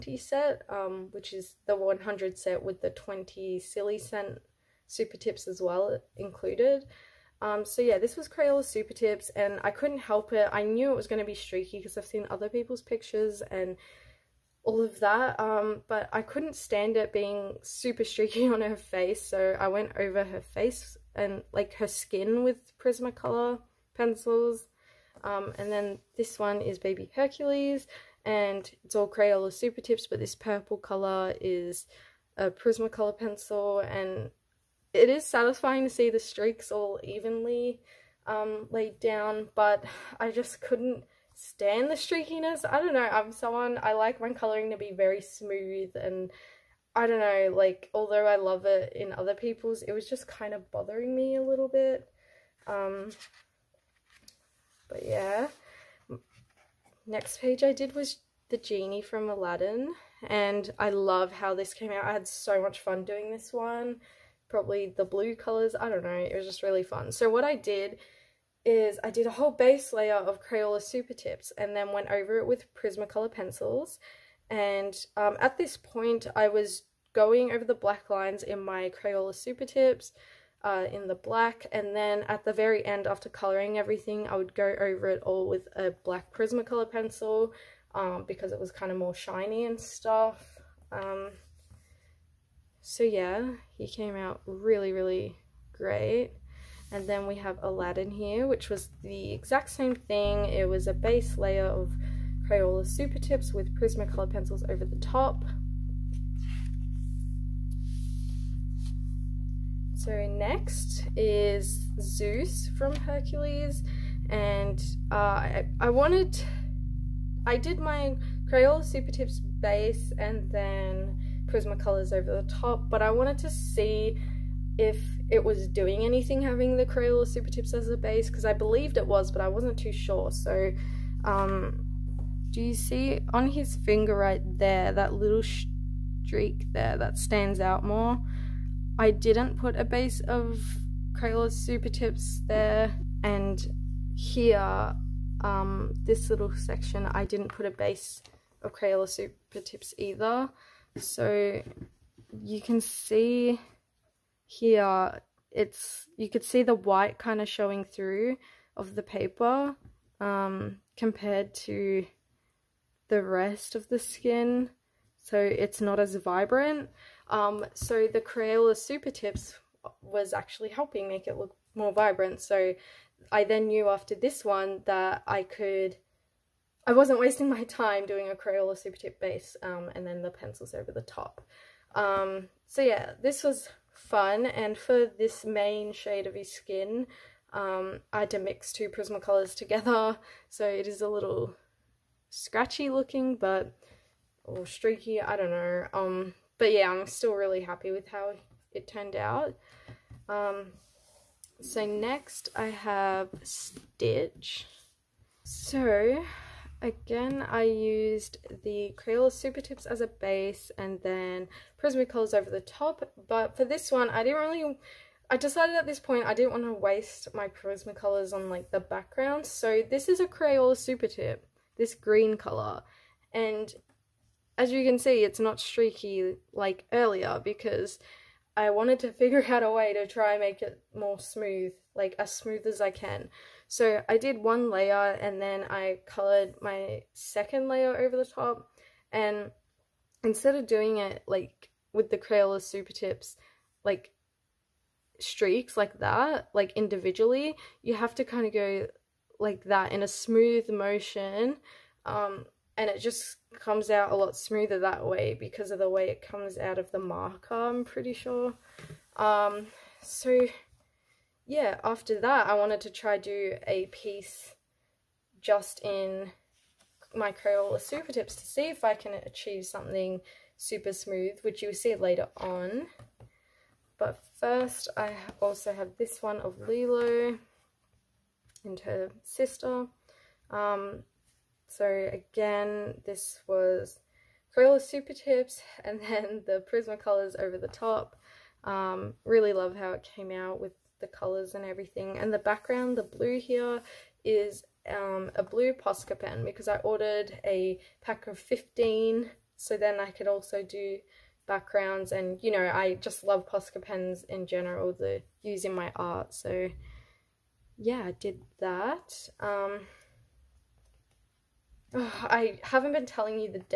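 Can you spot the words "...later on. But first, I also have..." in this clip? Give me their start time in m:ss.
4:31.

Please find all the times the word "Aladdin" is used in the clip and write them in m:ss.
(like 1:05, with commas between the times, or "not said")
0:59, 1:37.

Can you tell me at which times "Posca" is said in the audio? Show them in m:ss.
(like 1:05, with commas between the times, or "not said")
4:55, 5:03.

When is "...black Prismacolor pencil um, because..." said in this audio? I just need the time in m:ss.
1:26.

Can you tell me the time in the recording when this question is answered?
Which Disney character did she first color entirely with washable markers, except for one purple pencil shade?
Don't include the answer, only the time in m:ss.
0:26.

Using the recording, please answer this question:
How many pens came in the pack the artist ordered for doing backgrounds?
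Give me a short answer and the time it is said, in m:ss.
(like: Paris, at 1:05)
15, at 4:58.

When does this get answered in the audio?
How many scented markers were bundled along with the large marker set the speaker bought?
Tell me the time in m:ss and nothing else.
0:02.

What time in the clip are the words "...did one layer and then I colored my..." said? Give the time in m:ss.
3:54.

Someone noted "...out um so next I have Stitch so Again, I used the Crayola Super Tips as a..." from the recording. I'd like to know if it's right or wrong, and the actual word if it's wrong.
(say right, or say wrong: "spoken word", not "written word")
right.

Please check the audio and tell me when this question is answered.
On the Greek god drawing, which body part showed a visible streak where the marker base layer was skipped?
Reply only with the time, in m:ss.
2:13.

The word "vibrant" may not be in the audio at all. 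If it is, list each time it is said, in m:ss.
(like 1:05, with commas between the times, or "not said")
2:46, 2:51.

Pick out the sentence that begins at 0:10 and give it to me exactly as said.
I knew it was going to be streaky because I've seen other people's pictures and all of that.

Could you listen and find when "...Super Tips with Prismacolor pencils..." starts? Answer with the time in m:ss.
1:42.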